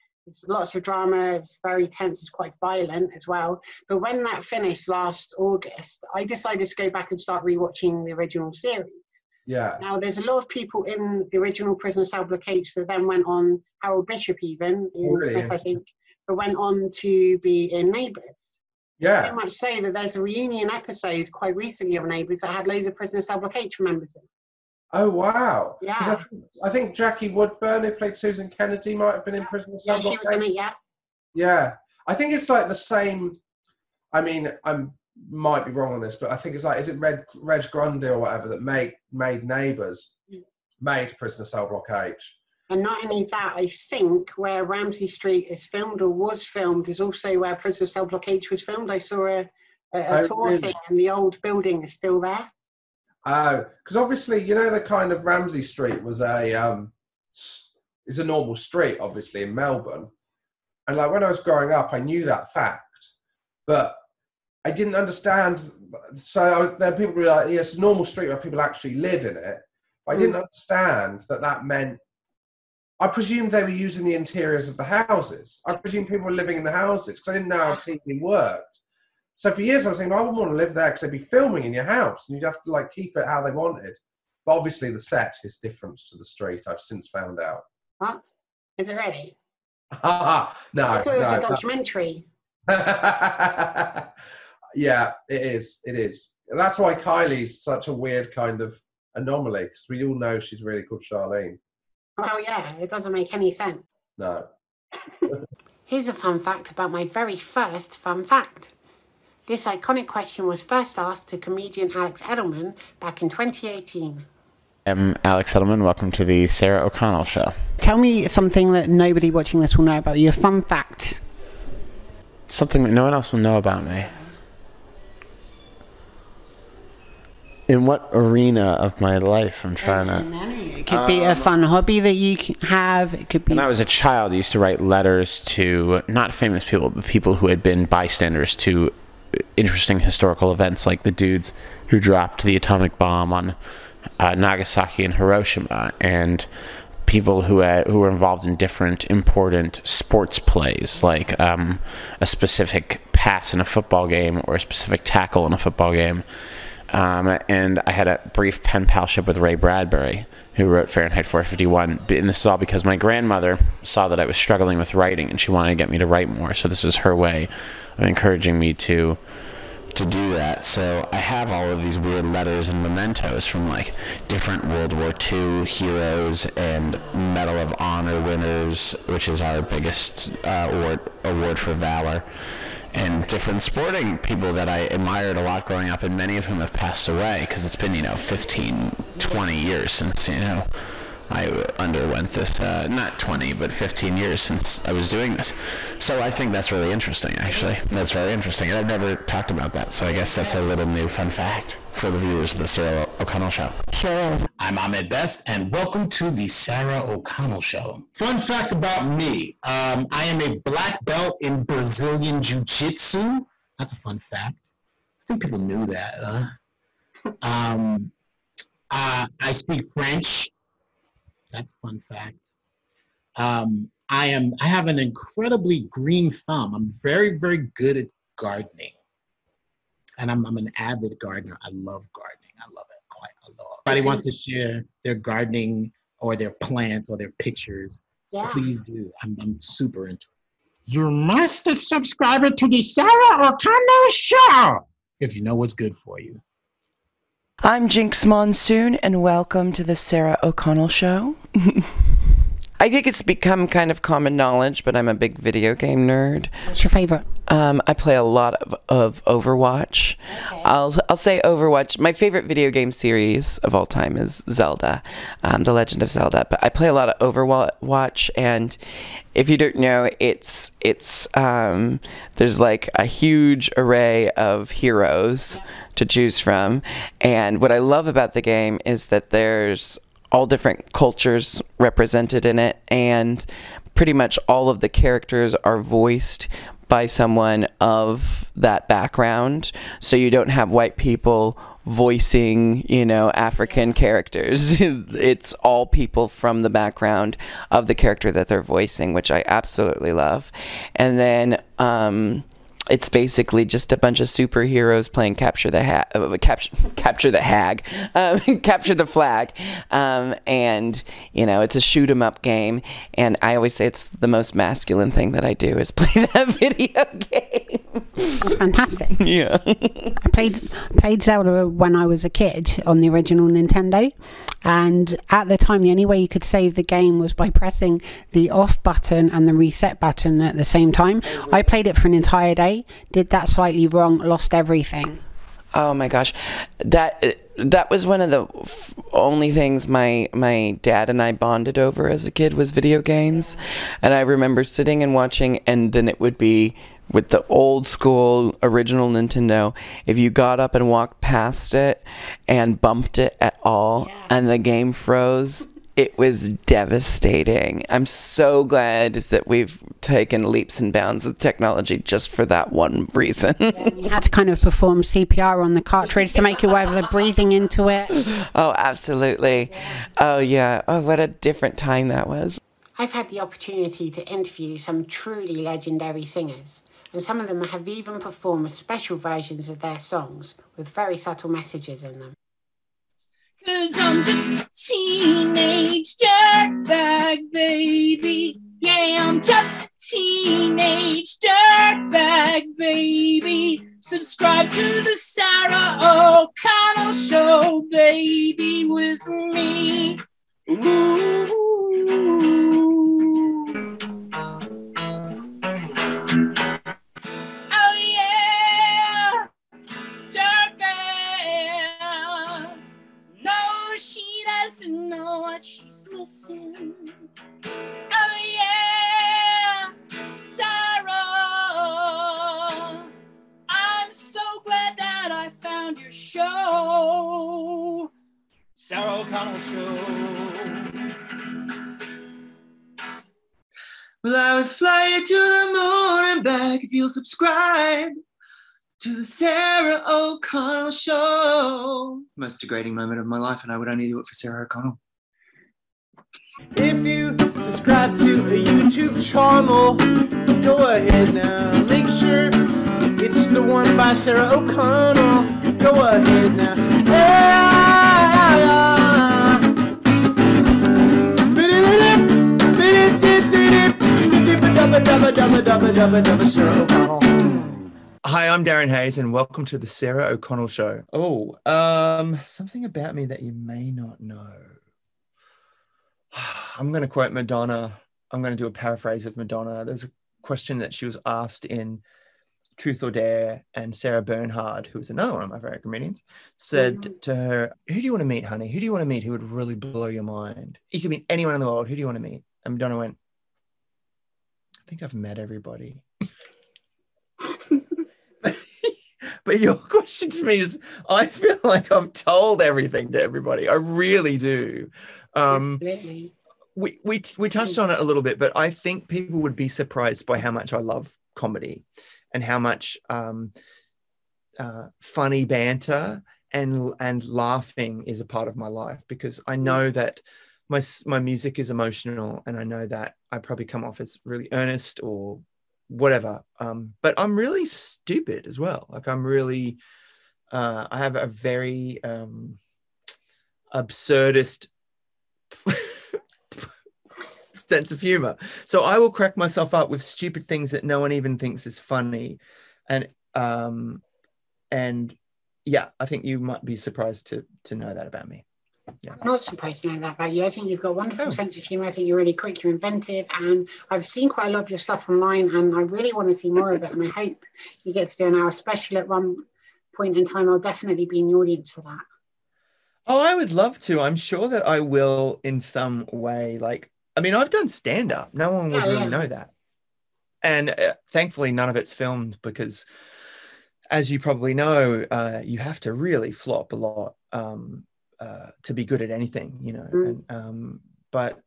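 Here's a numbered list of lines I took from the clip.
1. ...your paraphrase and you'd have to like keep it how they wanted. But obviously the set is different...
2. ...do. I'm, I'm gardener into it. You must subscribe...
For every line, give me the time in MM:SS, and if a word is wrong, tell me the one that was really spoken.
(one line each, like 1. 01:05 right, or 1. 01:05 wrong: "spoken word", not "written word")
1. 01:21 wrong: "house", not "paraphrase"
2. 03:58 wrong: "super", not "gardener".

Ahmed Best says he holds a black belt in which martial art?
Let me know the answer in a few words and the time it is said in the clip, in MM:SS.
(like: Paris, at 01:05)
Brazilian Jiu Jitsu, at 03:31.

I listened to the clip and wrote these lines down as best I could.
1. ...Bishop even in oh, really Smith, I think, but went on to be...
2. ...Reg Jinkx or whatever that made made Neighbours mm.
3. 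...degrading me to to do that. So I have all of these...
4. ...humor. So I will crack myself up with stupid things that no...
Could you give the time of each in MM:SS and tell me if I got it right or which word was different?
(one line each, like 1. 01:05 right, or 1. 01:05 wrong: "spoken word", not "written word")
1. 00:14 right
2. 00:37 wrong: "Grundy", not "Jinkx"
3. 02:48 wrong: "encouraging", not "degrading"
4. 08:57 right.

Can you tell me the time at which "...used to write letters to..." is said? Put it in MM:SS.
02:14.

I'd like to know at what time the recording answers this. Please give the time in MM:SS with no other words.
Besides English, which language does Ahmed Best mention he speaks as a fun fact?
03:39.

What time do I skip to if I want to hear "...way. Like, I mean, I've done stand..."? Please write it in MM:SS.
09:26.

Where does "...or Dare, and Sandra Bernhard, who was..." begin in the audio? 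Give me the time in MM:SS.
08:03.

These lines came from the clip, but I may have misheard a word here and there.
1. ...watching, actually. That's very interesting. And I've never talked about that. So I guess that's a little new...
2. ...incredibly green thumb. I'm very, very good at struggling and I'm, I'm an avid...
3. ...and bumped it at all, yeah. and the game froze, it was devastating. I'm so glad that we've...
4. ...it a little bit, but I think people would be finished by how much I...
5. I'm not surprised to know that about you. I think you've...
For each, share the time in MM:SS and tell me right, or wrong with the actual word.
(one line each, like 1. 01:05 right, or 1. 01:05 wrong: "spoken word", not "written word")
1. 03:16 wrong: "interesting", not "watching"
2. 03:44 wrong: "gardening", not "struggling"
3. 05:52 right
4. 08:27 wrong: "surprised", not "finished"
5. 09:09 right.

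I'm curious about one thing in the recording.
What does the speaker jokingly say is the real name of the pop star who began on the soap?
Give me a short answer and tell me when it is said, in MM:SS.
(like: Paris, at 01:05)
Charlene, at 01:41.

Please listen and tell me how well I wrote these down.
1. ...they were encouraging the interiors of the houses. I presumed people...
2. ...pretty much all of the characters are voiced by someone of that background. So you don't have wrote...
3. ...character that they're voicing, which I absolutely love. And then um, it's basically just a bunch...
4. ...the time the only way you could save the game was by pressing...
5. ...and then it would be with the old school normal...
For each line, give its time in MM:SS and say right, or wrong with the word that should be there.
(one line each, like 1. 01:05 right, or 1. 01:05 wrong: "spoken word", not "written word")
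1. 01:13 wrong: "using", not "encouraging"
2. 04:43 wrong: "white", not "wrote"
3. 04:57 right
4. 05:25 right
5. 05:45 wrong: "original", not "normal".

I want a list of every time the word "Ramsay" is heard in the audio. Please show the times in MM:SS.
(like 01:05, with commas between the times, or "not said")
00:44, 00:55.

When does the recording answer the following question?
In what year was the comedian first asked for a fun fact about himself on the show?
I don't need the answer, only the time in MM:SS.
01:53.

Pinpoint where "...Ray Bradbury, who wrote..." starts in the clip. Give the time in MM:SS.
02:39.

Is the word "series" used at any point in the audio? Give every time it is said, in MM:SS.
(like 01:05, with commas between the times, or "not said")
00:08, 04:22.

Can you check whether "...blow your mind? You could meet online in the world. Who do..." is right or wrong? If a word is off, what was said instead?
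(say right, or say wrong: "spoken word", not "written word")
wrong: "anyone", not "online".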